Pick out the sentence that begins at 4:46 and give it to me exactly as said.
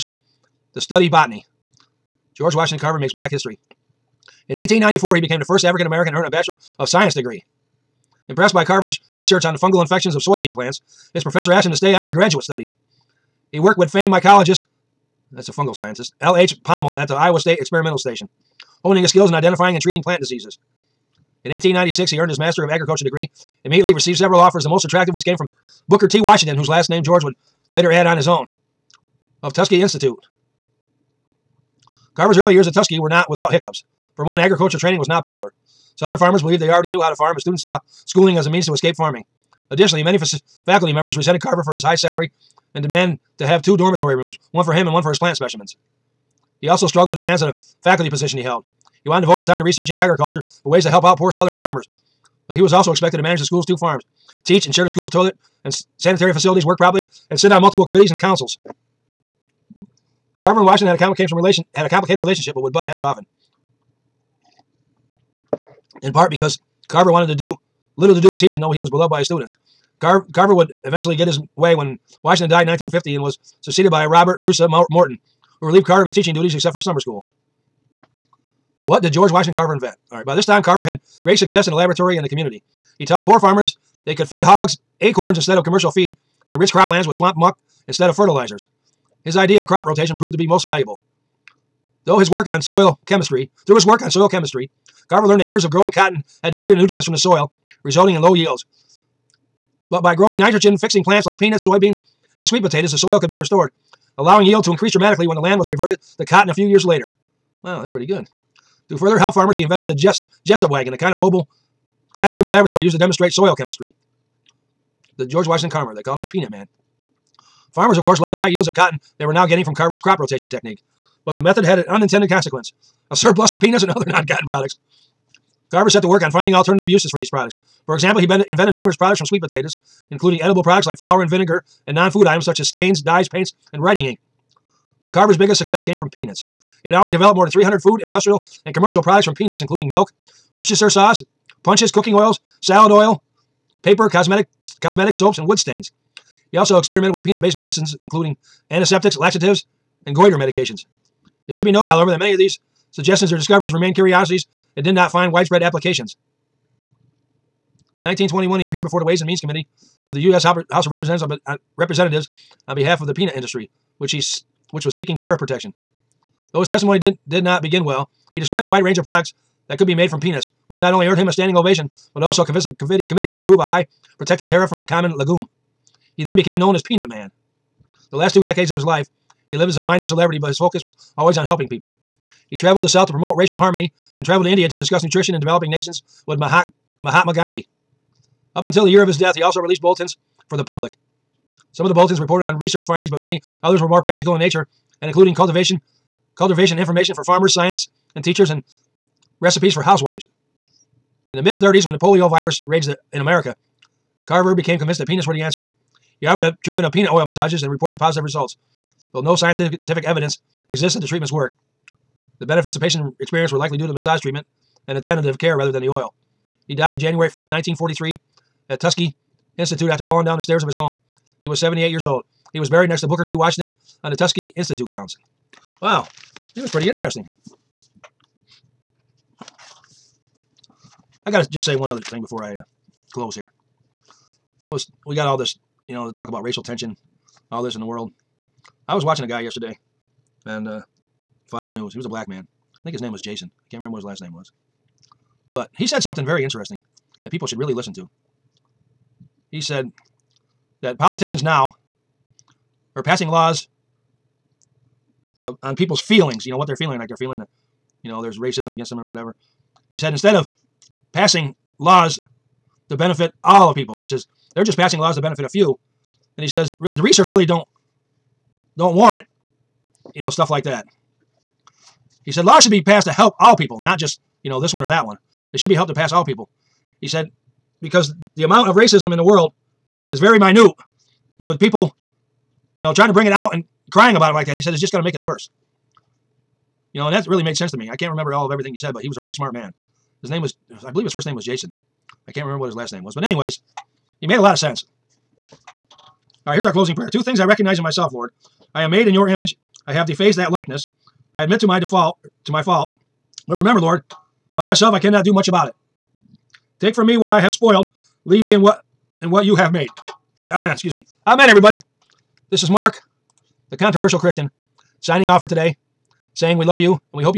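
You know, and that really made sense to me.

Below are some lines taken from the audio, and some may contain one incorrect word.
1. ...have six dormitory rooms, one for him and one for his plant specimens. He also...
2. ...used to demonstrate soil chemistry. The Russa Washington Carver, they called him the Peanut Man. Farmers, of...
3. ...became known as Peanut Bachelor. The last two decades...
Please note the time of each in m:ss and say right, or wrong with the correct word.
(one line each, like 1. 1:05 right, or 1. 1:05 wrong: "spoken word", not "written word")
1. 0:43 wrong: "two", not "six"
2. 1:52 wrong: "George", not "Russa"
3. 2:56 wrong: "Man", not "Bachelor".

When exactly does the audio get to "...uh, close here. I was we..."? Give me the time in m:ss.
3:52.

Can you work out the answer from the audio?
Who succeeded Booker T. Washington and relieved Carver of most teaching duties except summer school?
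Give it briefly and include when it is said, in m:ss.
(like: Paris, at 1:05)
Robert Russa Morton, at 1:14.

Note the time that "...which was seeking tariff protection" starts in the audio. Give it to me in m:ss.
2:44.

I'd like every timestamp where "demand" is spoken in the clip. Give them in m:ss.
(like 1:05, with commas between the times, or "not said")
0:42, 0:47.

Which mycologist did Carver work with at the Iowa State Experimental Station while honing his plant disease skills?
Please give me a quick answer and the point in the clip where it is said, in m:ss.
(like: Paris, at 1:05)
L.H. Pammel, at 0:16.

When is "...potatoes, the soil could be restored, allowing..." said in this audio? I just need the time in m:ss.
1:42.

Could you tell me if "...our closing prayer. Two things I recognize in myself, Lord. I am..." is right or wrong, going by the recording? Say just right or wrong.
right.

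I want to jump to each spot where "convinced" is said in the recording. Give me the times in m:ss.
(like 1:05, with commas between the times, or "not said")
2:52, 3:24.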